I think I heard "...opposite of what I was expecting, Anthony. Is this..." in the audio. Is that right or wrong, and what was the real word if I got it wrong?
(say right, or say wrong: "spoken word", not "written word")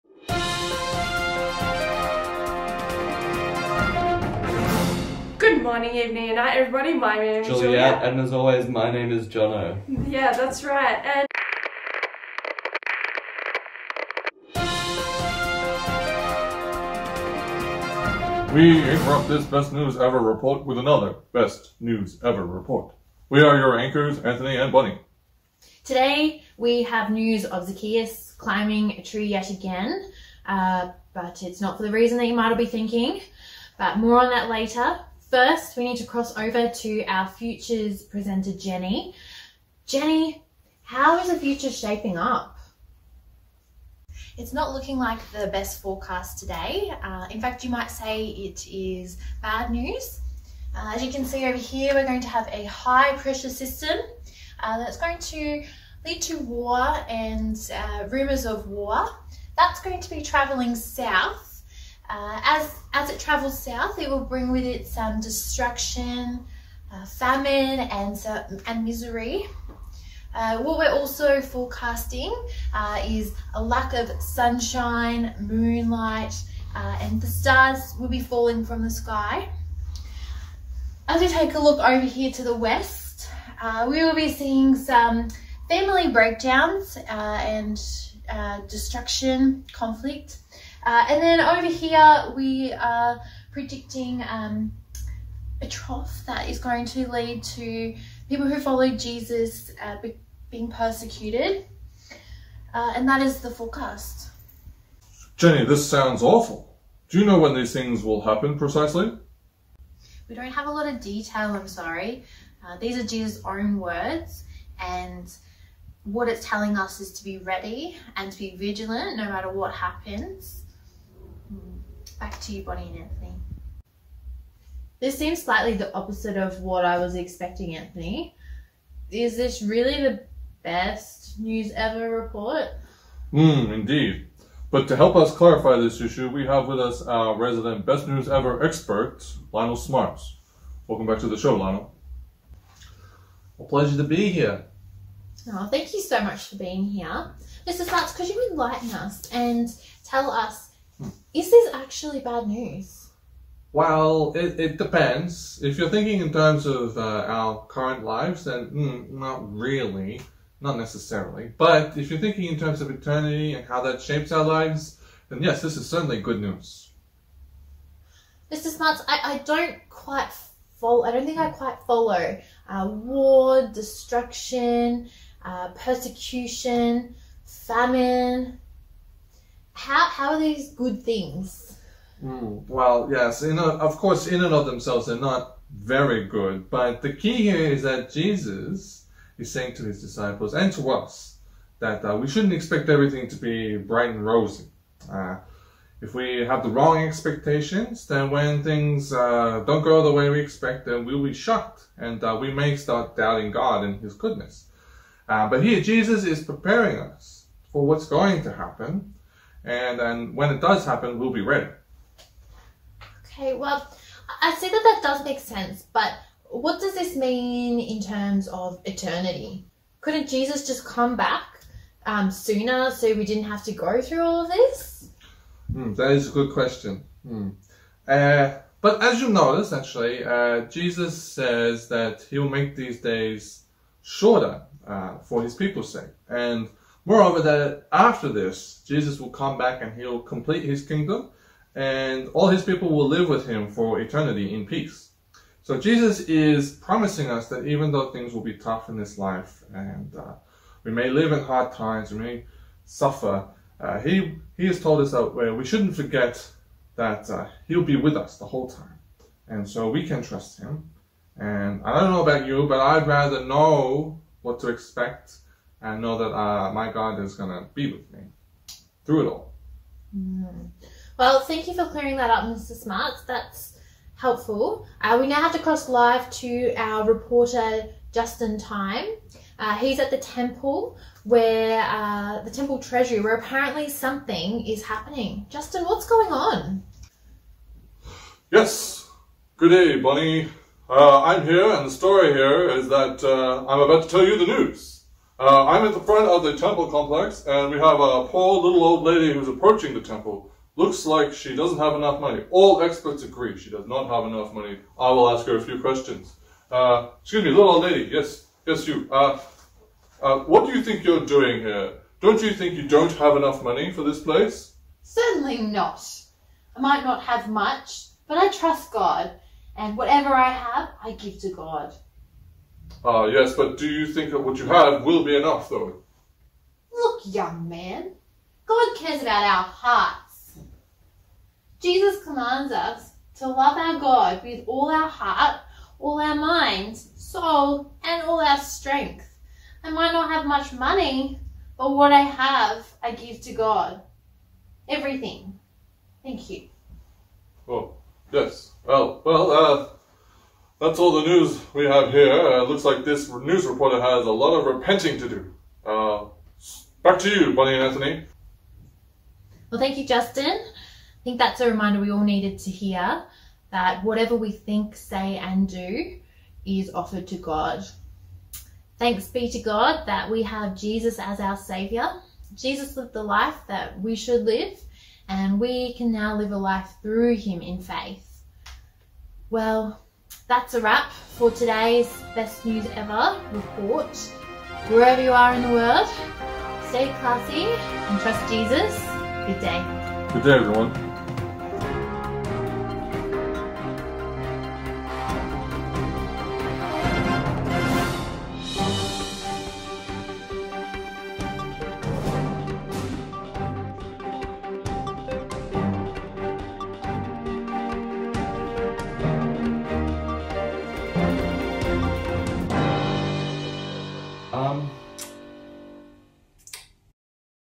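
right.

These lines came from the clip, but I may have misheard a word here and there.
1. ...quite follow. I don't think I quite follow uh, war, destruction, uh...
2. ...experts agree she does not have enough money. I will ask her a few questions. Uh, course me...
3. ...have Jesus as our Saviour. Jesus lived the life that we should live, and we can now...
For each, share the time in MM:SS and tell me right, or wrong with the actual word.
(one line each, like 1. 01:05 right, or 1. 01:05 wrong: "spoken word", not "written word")
1. 02:49 right
2. 05:02 wrong: "excuse", not "course"
3. 06:10 right.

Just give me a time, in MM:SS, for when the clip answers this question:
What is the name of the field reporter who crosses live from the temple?
04:38.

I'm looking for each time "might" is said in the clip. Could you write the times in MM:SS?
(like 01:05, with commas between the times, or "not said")
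00:32, 00:47, 05:16, 05:39.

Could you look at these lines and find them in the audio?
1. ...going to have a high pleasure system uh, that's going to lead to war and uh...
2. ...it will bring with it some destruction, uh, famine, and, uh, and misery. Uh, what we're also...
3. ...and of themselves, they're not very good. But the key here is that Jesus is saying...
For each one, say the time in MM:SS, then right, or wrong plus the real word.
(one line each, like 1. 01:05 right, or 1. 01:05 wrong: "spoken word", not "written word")
1. 00:52 wrong: "pressure", not "pleasure"
2. 01:03 right
3. 03:04 right.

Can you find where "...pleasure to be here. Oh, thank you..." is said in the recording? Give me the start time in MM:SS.
02:23.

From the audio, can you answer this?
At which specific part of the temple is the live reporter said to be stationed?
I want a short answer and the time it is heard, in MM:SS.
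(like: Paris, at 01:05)
the temple treasury, at 04:42.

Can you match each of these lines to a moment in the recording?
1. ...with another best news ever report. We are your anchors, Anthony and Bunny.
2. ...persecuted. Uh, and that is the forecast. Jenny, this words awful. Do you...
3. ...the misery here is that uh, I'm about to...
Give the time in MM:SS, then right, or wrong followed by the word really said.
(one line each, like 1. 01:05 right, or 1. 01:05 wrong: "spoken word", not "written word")
1. 00:20 right
2. 01:40 wrong: "sounds", not "words"
3. 04:51 wrong: "story", not "misery".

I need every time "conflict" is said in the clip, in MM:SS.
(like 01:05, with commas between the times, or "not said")
01:29.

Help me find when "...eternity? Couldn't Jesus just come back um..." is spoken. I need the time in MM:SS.
03:38.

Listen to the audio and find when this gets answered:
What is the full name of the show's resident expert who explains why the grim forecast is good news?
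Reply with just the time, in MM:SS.
02:19.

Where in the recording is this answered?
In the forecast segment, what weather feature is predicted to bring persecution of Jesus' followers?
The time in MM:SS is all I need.
01:35.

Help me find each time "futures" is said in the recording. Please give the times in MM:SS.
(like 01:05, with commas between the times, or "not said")
00:37, 00:41.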